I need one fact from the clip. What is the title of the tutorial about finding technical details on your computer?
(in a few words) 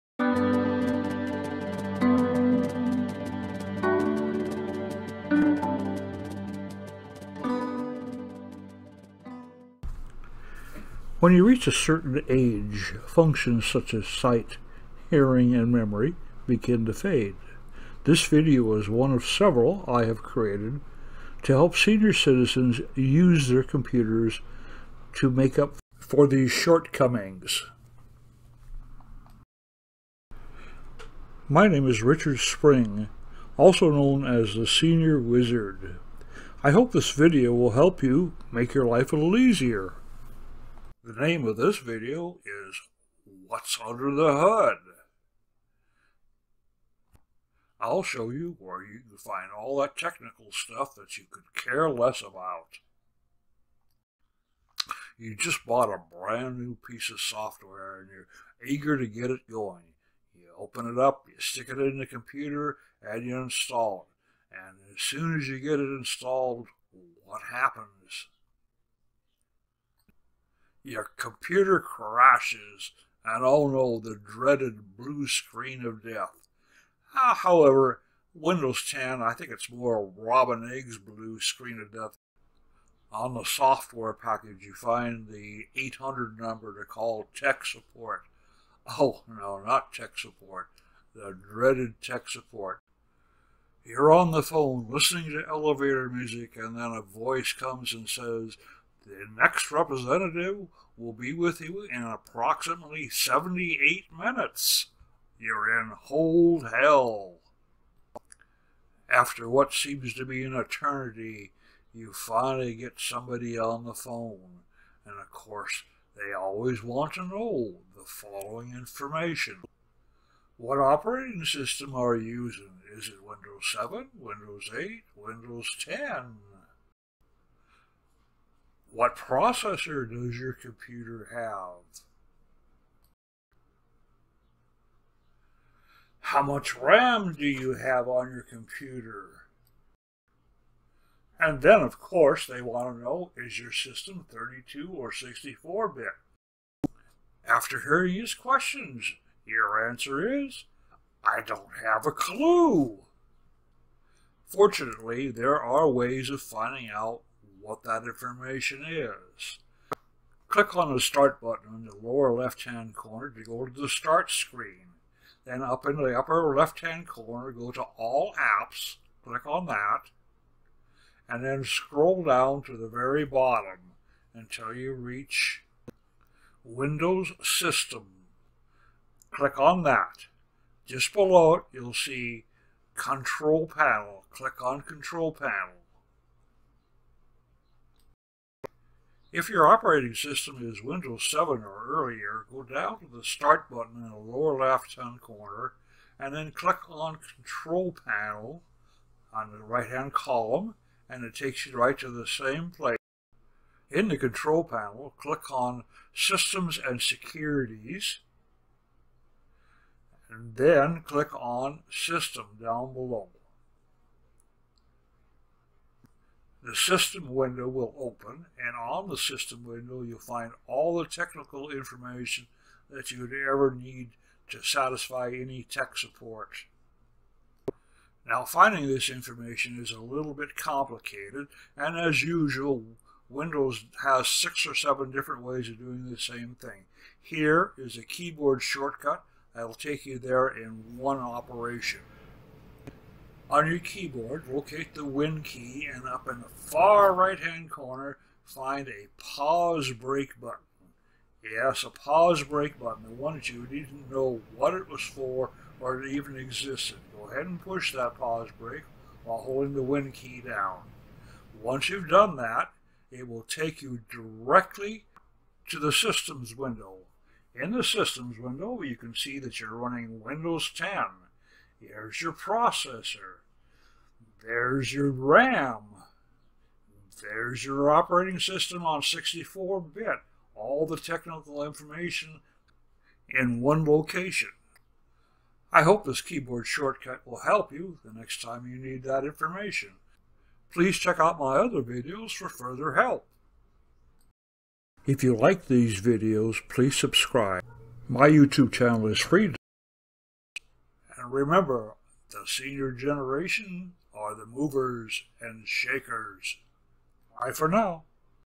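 What's Under the Hood?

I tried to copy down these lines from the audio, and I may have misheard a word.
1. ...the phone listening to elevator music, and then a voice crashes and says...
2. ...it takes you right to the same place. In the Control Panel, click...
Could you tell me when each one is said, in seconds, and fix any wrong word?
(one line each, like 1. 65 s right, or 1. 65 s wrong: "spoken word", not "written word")
1. 94 s wrong: "comes", not "crashes"
2. 201 s right.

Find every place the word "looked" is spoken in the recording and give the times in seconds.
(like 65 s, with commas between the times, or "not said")
not said.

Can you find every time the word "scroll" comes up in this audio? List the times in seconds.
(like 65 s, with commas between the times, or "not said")
171 s.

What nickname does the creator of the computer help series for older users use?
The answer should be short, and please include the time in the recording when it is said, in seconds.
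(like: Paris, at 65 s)
Senior Wizard, at 34 s.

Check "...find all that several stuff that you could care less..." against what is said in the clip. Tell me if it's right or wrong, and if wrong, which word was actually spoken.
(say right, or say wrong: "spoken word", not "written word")
wrong: "technical", not "several".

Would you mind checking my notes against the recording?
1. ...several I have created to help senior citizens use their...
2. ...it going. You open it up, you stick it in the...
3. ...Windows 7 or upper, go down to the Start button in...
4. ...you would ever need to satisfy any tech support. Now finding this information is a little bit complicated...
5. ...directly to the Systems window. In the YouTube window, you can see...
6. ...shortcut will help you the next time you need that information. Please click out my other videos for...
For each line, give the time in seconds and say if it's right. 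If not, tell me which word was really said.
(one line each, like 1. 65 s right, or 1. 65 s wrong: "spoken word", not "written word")
1. 19 s right
2. 59 s right
3. 190 s wrong: "earlier", not "upper"
4. 223 s right
5. 264 s wrong: "Systems", not "YouTube"
6. 286 s wrong: "check", not "click".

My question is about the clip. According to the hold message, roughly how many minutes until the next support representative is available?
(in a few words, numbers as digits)
78.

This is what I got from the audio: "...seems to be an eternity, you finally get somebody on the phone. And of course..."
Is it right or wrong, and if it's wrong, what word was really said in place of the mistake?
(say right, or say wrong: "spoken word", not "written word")
right.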